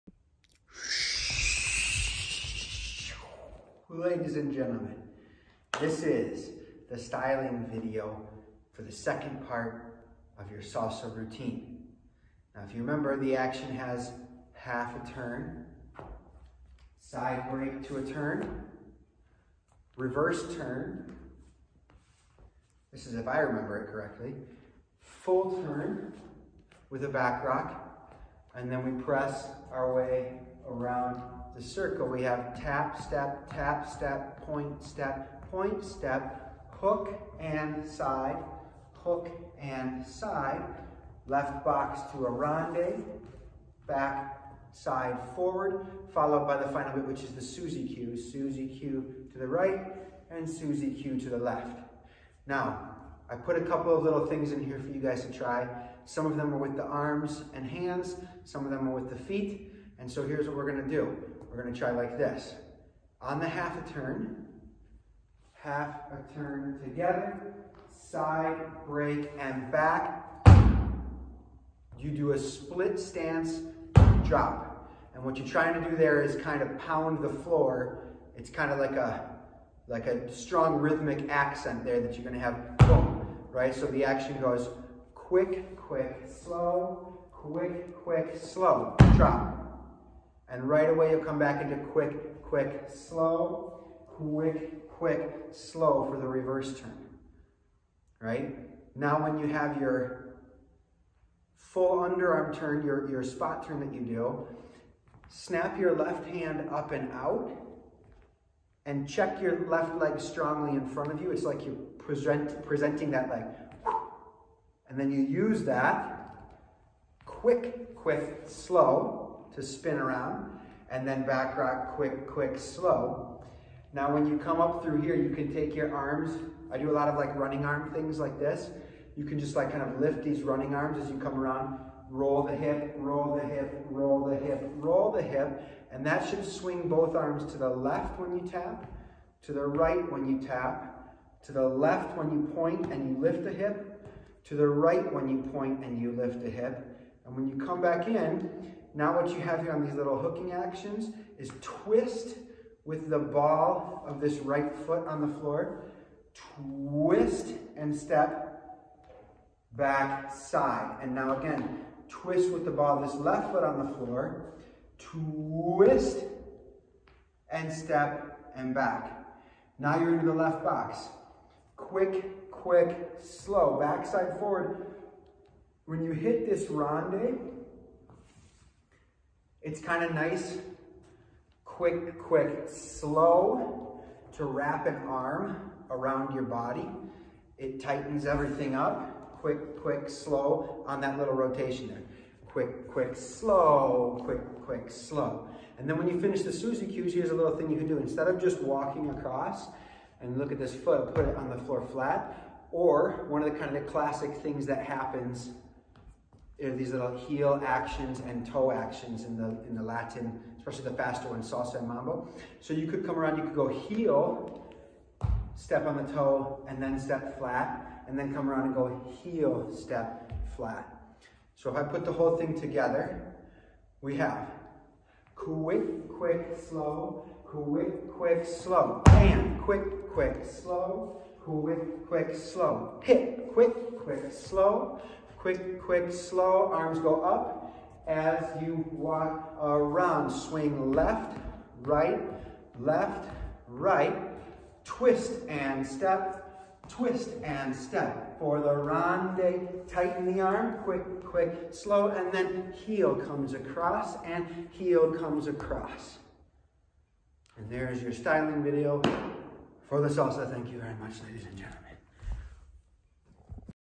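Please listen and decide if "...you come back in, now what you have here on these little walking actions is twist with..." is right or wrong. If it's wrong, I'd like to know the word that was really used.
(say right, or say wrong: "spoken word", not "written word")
wrong: "hooking", not "walking".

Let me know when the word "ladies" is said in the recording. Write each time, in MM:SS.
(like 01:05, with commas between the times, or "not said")
00:03, 04:21.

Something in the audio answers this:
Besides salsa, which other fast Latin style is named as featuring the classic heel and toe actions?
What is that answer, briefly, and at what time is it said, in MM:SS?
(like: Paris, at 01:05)
mambo, at 03:31.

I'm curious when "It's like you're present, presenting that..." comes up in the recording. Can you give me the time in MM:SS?
01:51.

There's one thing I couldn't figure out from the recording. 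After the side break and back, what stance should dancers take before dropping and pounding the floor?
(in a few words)
split stance.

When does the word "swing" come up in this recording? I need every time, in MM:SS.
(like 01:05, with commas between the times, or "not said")
02:16, 04:00.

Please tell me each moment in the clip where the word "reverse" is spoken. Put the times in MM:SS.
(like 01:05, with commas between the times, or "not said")
00:19, 01:36.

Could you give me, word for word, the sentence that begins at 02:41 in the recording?
And now again, twist with the ball of this left foot on the floor, twist and step and back.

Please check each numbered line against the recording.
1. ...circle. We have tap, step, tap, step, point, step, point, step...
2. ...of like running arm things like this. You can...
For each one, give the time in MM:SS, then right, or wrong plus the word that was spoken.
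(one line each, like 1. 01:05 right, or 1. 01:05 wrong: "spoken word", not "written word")
1. 00:31 right
2. 02:07 right.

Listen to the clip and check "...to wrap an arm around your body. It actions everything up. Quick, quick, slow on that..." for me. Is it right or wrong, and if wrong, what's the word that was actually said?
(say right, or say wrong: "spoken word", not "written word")
wrong: "tightens", not "actions".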